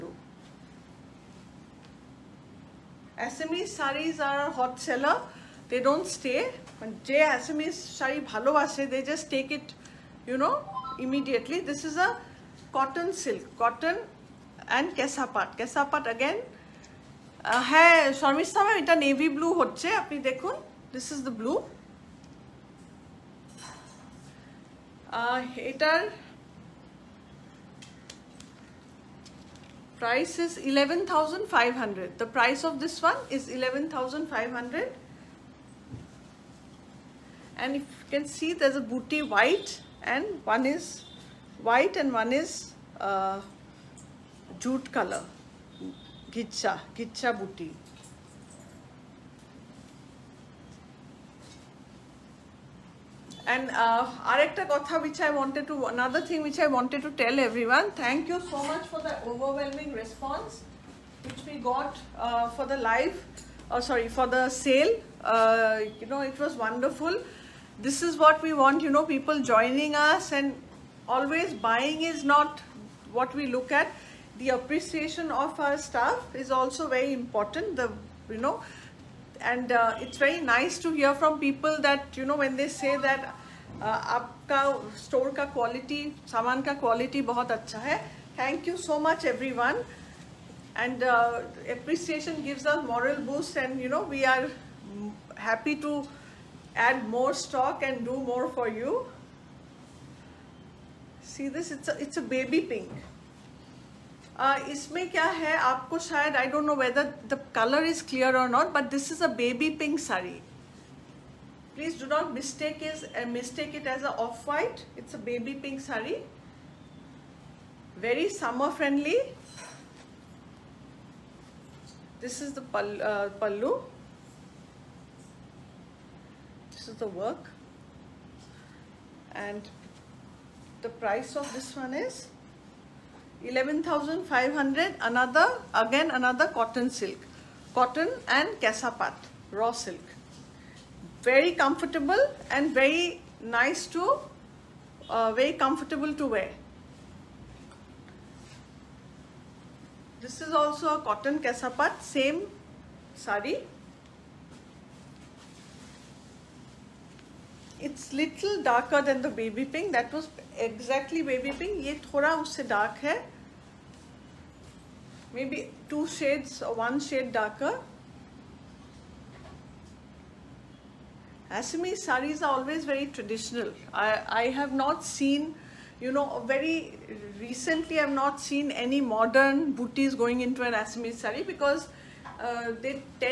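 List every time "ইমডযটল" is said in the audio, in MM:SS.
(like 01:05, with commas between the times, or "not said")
00:11.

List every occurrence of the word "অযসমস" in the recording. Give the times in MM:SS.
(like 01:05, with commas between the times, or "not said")
00:03, 00:07.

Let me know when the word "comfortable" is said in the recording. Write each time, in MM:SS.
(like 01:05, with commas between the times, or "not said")
02:21, 02:25.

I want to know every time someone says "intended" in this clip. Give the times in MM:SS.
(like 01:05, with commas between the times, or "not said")
not said.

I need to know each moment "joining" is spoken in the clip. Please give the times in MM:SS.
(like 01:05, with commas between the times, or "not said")
01:09.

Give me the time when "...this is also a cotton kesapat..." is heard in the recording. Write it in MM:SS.
02:30.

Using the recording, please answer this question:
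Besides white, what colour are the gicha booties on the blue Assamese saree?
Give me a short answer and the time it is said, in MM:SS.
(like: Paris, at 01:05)
Jute, at 00:44.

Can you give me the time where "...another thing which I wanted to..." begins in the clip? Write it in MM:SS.
00:55.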